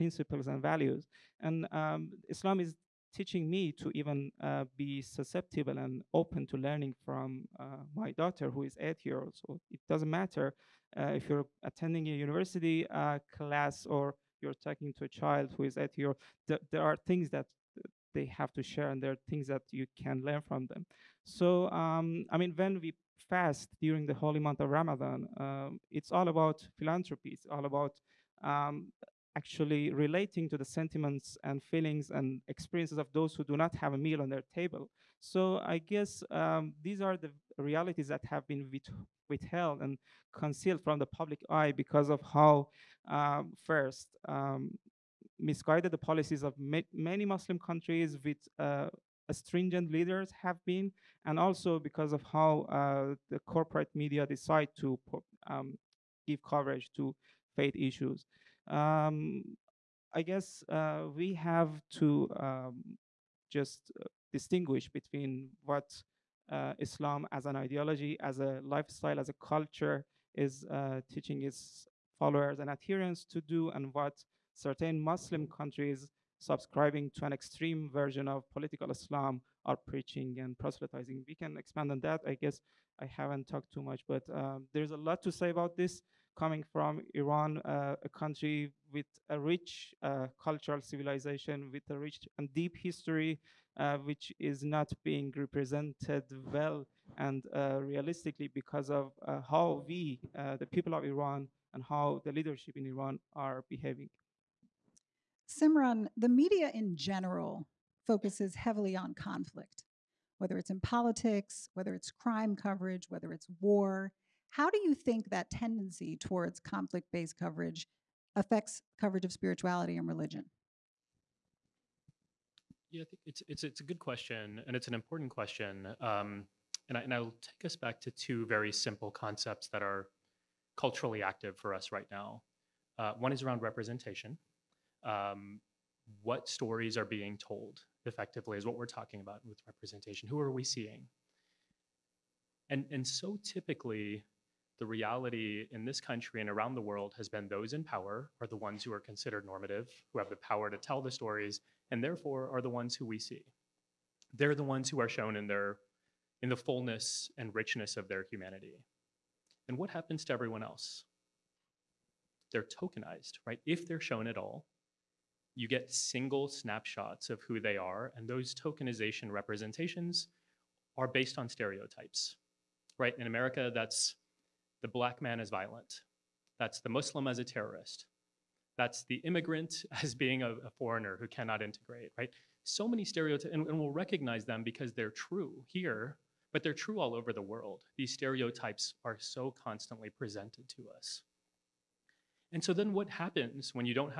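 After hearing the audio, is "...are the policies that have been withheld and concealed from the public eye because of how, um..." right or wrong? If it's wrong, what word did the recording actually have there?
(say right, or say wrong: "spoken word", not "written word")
wrong: "realities", not "policies".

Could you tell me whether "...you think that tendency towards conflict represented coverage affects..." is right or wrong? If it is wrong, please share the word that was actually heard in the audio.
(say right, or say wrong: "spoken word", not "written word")
wrong: "based", not "represented".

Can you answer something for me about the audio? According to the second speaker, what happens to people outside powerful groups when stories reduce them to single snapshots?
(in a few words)
They're tokenized.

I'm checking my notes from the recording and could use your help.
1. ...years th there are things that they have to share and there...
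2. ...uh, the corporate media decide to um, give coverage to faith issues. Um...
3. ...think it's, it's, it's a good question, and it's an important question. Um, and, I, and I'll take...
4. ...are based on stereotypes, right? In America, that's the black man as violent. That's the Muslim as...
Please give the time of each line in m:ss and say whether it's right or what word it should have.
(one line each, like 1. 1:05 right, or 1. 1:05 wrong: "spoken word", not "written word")
1. 0:15 right
2. 0:52 right
3. 2:03 right
4. 2:50 right.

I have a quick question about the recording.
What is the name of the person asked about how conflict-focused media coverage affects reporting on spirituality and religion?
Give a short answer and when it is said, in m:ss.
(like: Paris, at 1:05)
Simran, at 1:45.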